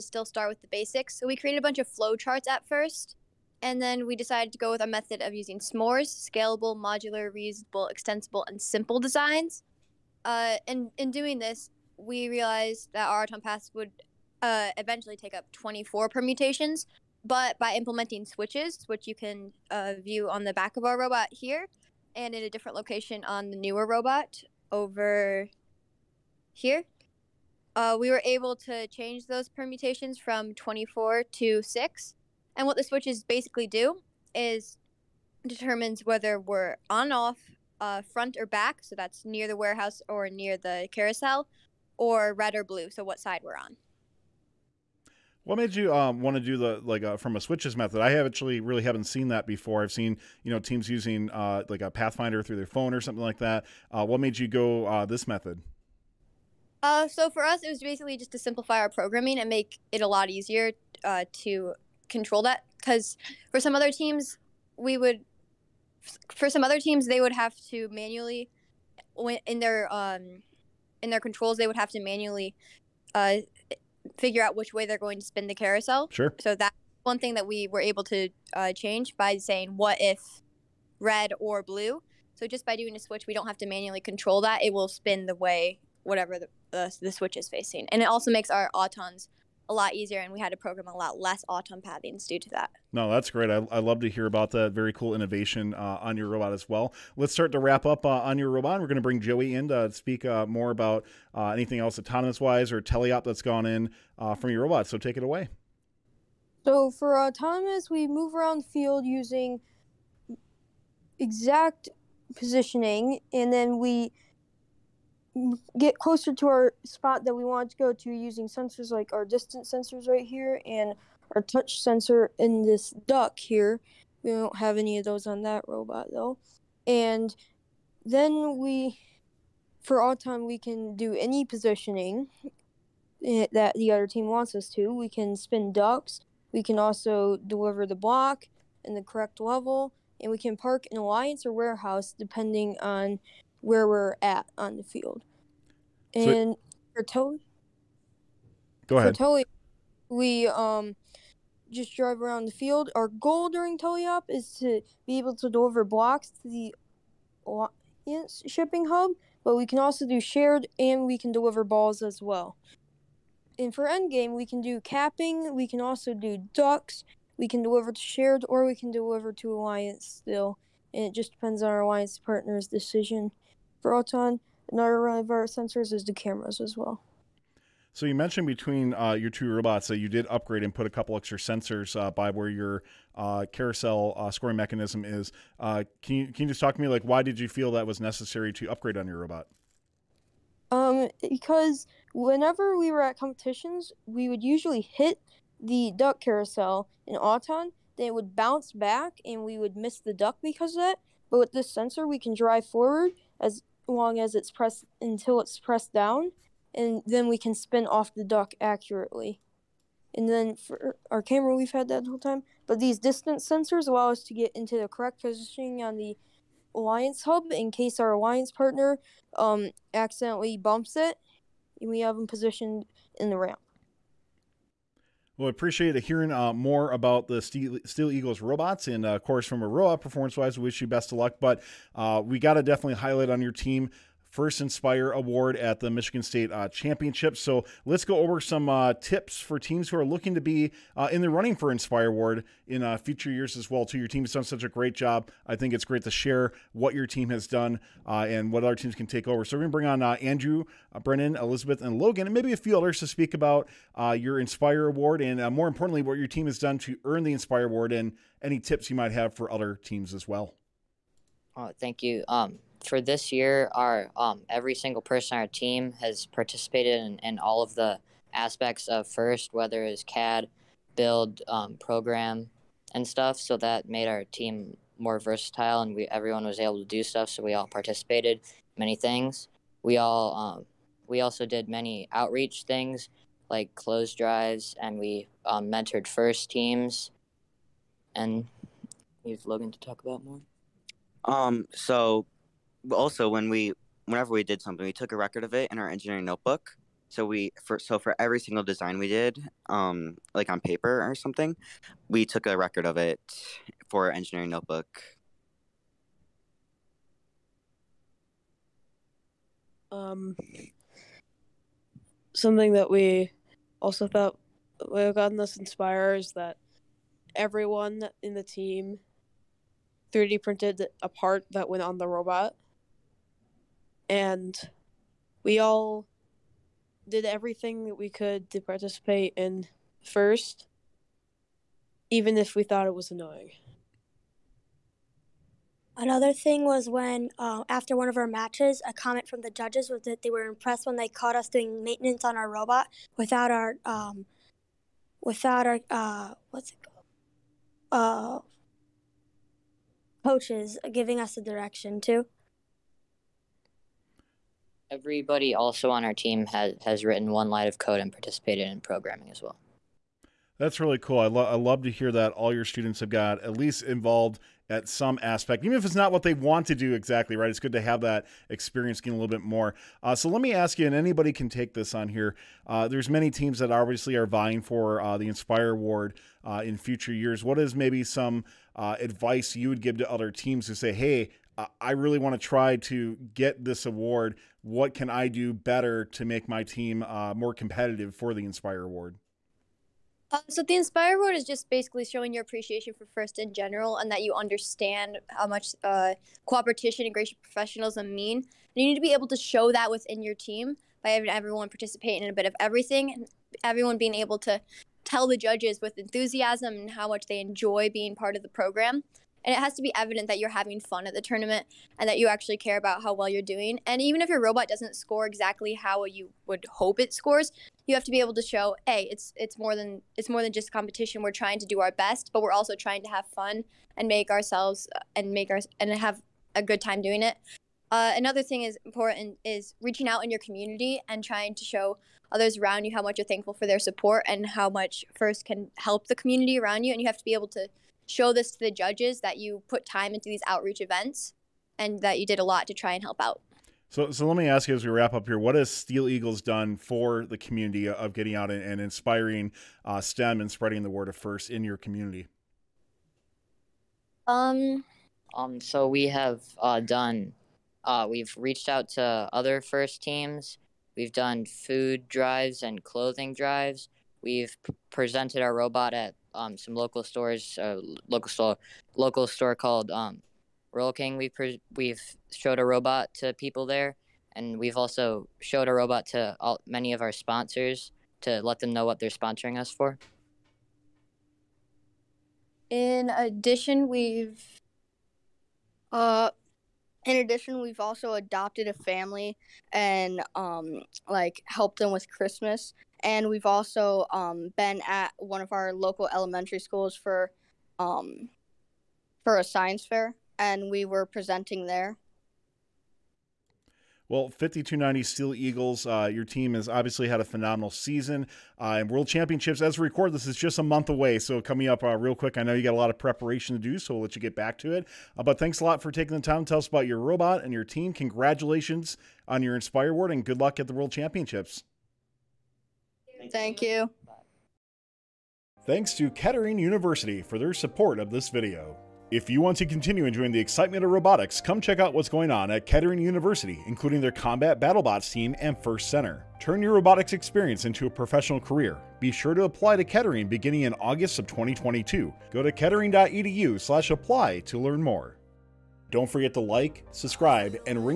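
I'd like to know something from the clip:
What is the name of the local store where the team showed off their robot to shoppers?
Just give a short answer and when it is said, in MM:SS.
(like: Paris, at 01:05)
Royal King, at 07:50.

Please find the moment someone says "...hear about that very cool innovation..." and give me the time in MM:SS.
01:34.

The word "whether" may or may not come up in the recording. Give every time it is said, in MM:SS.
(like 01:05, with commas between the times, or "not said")
00:36, 04:29.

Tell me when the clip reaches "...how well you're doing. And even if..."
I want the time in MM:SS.
06:53.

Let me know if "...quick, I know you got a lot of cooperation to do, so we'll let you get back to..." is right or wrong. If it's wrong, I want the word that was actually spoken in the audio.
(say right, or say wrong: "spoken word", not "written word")
wrong: "preparation", not "cooperation".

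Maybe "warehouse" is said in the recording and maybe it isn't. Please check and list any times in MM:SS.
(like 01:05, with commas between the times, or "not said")
00:39, 02:21.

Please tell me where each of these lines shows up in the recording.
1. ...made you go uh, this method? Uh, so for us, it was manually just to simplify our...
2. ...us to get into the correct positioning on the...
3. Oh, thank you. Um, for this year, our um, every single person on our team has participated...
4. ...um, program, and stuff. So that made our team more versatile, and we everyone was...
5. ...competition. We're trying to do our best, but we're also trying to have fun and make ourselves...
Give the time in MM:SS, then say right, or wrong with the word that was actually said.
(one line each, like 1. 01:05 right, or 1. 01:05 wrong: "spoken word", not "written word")
1. 00:54 wrong: "basically", not "manually"
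2. 03:34 right
3. 04:21 right
4. 04:31 right
5. 07:00 right.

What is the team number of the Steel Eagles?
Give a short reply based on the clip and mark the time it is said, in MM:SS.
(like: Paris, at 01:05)
5290, at 08:24.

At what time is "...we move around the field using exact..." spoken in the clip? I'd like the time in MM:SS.
01:47.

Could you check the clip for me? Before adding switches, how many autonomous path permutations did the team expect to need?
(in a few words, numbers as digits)
24.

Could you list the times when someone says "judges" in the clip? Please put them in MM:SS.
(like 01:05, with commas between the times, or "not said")
05:39, 06:45, 07:18.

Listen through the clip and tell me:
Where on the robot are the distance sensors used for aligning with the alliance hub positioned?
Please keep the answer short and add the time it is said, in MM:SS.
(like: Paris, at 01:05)
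in the ramp, at 03:43.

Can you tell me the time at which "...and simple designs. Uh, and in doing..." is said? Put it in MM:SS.
00:08.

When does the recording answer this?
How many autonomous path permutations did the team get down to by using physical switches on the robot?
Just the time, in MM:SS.
00:31.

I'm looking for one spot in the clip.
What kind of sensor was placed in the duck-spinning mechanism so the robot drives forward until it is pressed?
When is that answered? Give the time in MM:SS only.
02:01.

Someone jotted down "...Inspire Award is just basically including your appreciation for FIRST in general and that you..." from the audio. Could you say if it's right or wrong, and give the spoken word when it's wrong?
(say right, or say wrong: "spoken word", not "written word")
wrong: "showing", not "including".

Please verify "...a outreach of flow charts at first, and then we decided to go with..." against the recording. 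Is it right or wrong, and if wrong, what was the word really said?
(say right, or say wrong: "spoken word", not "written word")
wrong: "bunch", not "outreach".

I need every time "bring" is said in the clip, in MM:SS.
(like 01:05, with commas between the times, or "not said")
01:39, 04:09.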